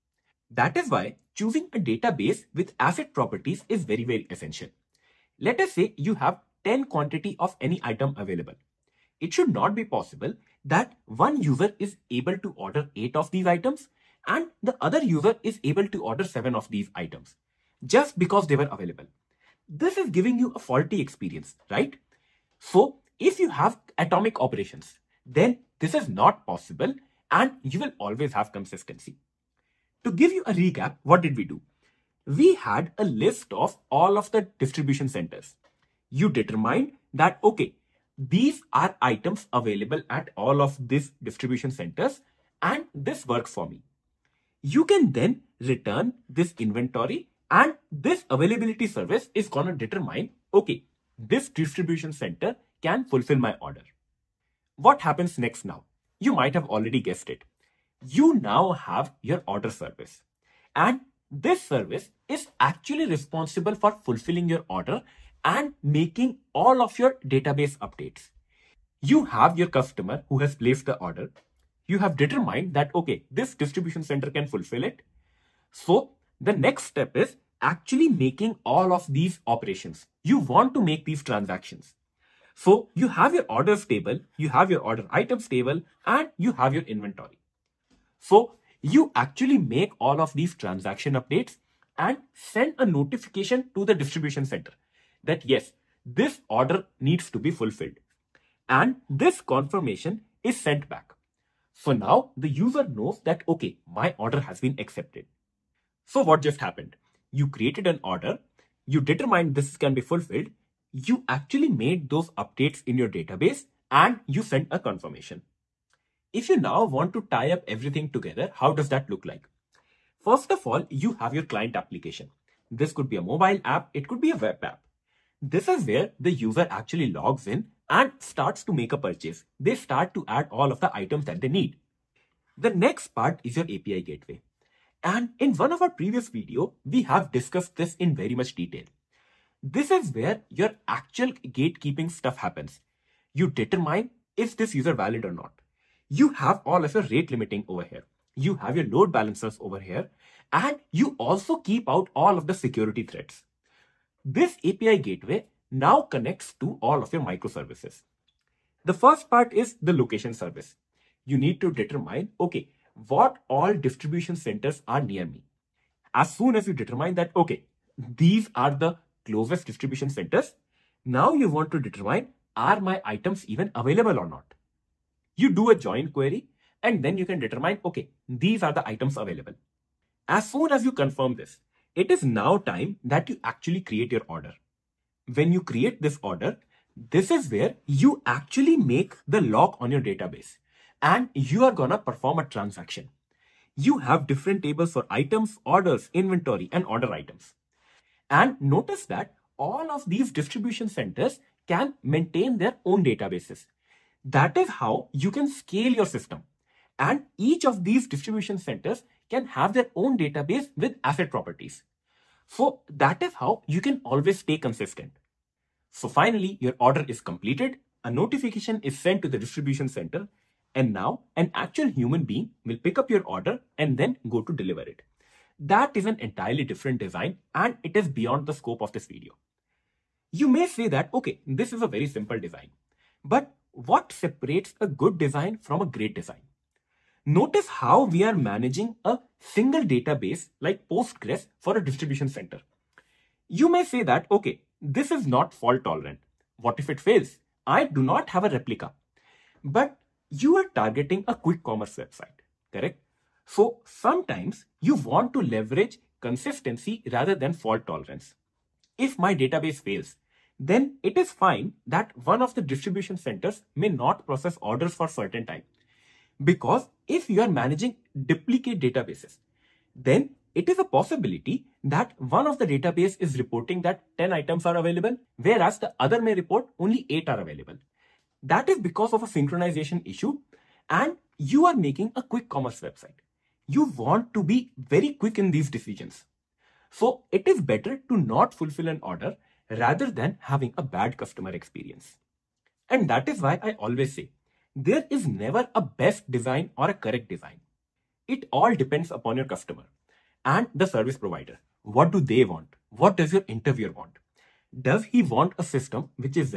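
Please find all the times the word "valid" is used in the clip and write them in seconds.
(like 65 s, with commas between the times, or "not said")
144 s.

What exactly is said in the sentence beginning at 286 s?
So it is better to not fulfill an order rather than having a bad customer experience.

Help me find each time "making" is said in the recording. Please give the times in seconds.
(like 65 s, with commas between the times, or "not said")
65 s, 78 s, 281 s.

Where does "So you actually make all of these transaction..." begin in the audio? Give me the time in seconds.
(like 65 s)
88 s.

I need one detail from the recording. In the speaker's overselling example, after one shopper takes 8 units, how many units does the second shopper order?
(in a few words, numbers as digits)
7.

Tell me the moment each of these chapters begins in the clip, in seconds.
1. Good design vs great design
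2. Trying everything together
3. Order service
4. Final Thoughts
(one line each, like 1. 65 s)
1. 229 s
2. 115 s
3. 64 s
4. 293 s.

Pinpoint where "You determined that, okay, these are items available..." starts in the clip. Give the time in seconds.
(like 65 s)
36 s.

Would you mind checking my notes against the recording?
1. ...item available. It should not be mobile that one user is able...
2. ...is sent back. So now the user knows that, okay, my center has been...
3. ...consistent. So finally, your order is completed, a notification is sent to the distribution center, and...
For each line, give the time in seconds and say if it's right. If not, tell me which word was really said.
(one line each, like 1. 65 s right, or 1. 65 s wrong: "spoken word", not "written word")
1. 7 s wrong: "possible", not "mobile"
2. 100 s wrong: "order", not "center"
3. 214 s right.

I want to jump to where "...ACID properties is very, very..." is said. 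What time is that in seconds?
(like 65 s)
2 s.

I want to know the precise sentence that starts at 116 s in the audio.
If you now want to tie up everything together, how does that look like?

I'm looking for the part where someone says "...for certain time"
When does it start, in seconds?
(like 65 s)
264 s.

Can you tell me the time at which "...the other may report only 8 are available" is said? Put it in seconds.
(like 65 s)
275 s.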